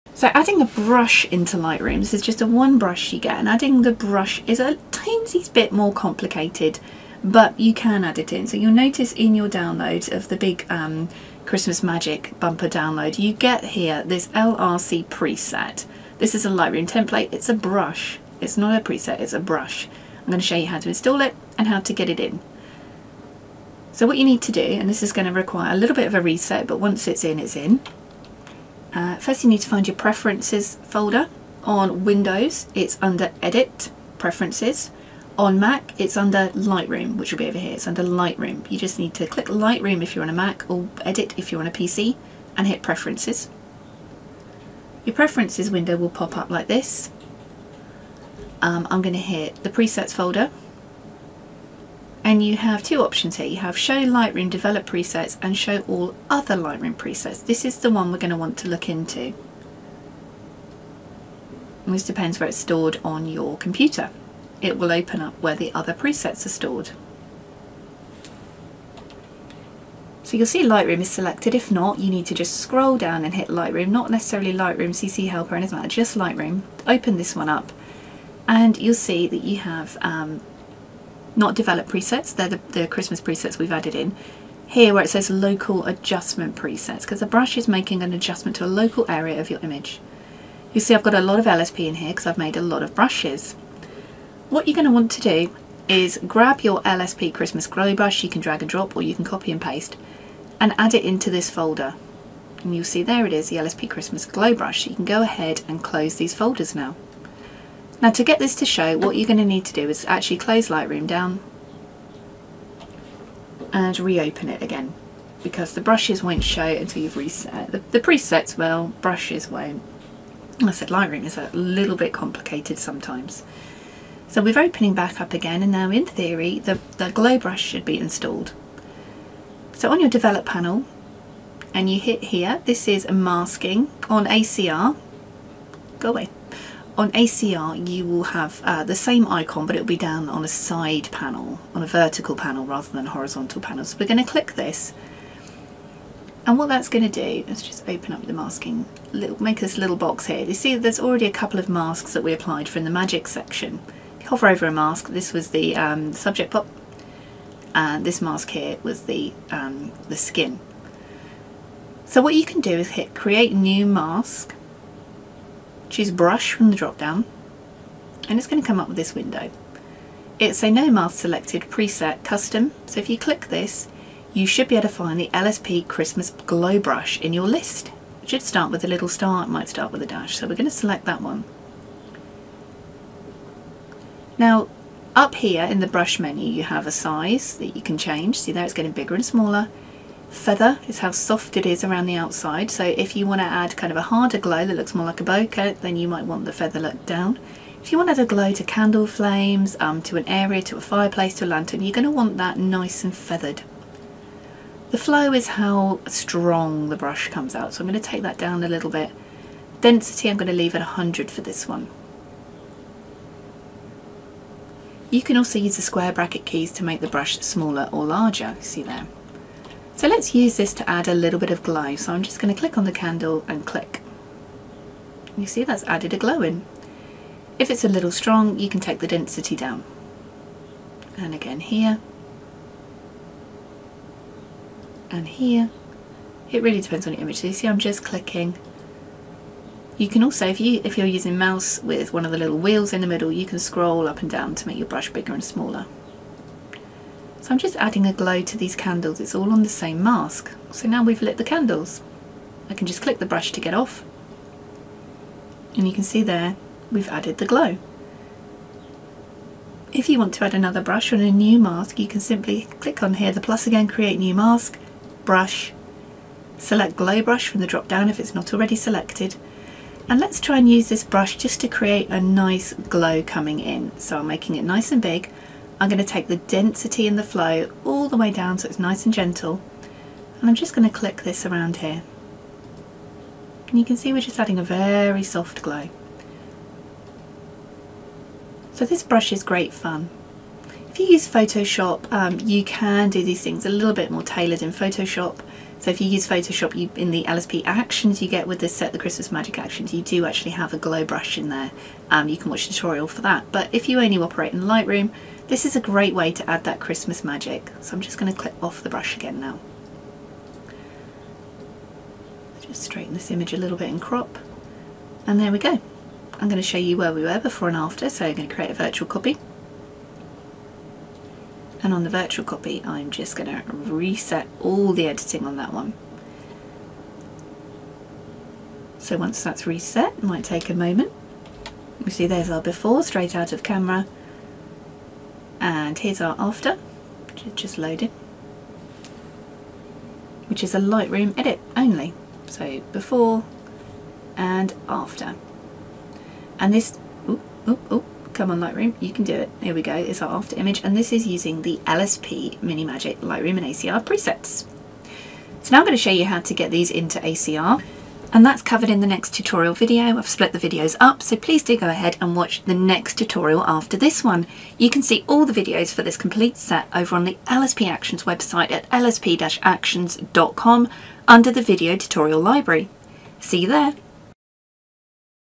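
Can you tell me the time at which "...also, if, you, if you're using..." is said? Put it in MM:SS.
04:00.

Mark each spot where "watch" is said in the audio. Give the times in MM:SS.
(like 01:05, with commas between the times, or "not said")
05:02, 06:02.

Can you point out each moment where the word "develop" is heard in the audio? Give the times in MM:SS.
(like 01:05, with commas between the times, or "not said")
00:54, 01:21, 02:10.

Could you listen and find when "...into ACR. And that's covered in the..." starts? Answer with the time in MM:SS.
05:56.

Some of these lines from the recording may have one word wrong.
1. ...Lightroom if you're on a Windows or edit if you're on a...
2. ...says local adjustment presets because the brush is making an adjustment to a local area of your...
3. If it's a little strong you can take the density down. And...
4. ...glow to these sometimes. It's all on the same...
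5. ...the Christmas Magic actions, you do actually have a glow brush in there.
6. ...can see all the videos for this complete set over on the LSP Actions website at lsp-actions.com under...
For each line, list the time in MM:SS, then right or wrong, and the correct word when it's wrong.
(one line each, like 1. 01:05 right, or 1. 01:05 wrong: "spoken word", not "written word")
1. 00:39 wrong: "Mac", not "Windows"
2. 01:25 right
3. 03:47 right
4. 04:08 wrong: "candles", not "sometimes"
5. 04:58 right
6. 06:04 right.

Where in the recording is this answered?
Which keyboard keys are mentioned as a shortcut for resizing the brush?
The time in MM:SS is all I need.
03:35.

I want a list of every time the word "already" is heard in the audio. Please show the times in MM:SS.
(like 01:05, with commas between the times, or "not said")
02:30, 04:28.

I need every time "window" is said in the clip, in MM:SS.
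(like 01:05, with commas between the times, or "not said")
00:32, 00:45, 02:49.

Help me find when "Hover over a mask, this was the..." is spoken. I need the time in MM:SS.
02:34.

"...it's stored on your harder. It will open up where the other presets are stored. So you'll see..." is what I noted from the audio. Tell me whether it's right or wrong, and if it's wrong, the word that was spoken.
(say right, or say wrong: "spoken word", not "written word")
wrong: "computer", not "harder".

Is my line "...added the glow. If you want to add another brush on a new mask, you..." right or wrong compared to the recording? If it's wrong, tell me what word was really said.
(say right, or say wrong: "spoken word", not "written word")
right.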